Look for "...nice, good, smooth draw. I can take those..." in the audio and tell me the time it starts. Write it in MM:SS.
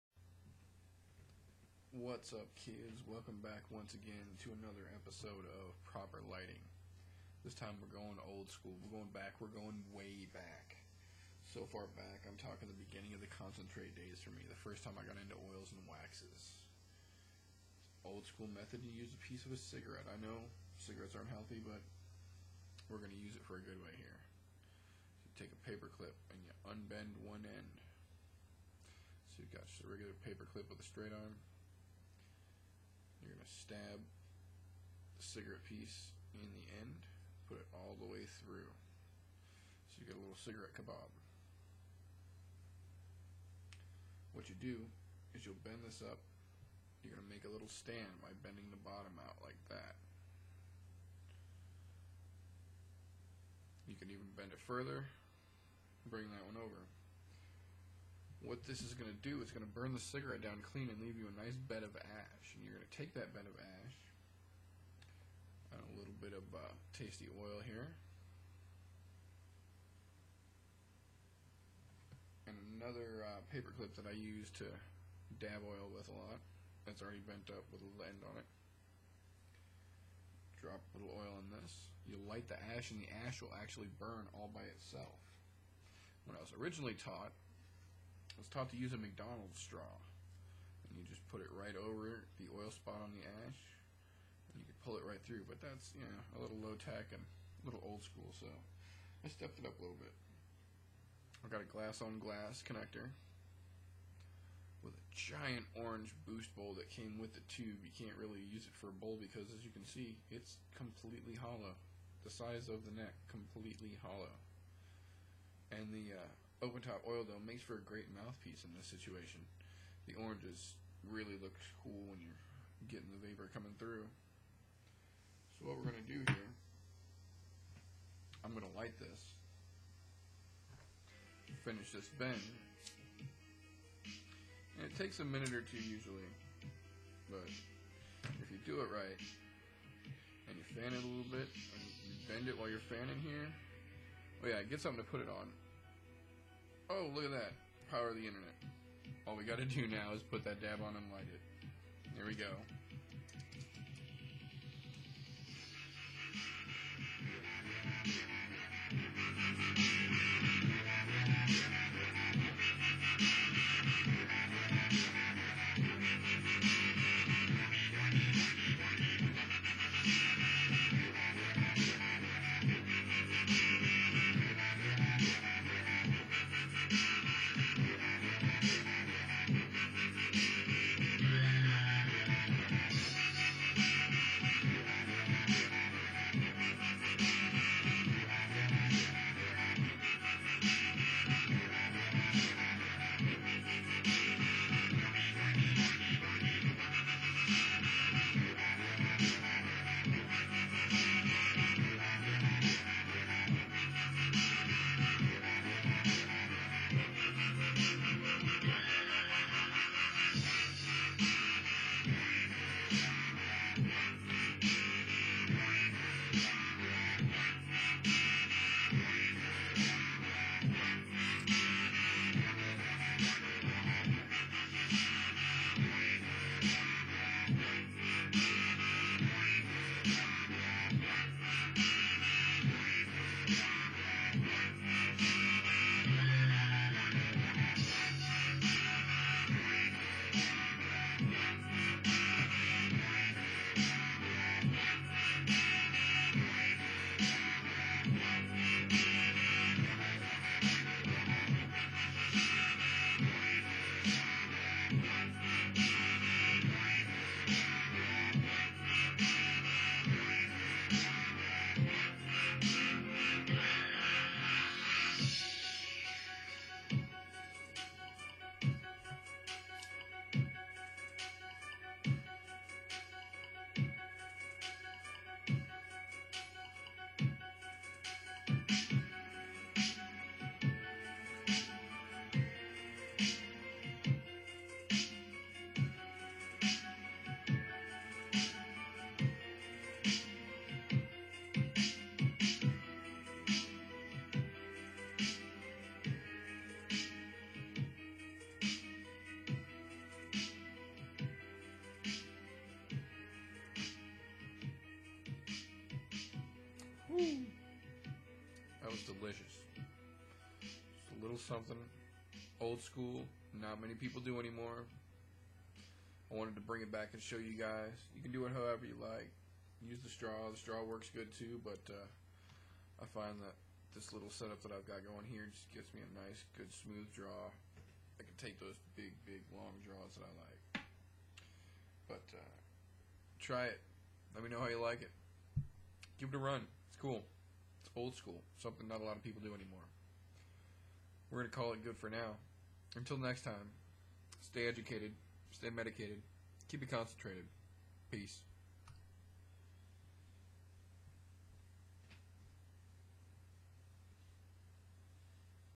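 05:26.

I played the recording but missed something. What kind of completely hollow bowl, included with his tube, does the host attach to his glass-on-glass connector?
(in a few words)
orange boost bowl.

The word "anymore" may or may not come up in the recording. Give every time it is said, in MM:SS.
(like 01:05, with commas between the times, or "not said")
05:14, 05:39.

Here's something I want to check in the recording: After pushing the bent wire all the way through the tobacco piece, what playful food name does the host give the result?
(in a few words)
cigarette kebab.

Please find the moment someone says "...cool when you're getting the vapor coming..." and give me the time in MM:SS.
02:01.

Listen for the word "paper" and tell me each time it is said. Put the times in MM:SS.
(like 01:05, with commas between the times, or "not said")
00:25, 00:30, 01:13.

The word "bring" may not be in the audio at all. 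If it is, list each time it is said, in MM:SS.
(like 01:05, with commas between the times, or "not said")
00:56, 05:16.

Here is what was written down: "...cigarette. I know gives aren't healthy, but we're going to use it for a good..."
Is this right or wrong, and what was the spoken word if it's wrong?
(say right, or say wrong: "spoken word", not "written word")
wrong: "cigarettes", not "gives".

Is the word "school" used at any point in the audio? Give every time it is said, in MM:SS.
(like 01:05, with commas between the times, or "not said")
00:08, 00:18, 01:38, 05:12, 05:38.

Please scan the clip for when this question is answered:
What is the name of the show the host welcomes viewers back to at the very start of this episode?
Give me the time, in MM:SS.
00:05.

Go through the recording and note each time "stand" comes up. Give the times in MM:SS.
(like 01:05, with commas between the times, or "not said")
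00:47.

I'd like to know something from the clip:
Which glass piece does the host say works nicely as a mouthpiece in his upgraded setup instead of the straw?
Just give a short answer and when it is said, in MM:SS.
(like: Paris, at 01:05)
open top oil dome, at 01:56.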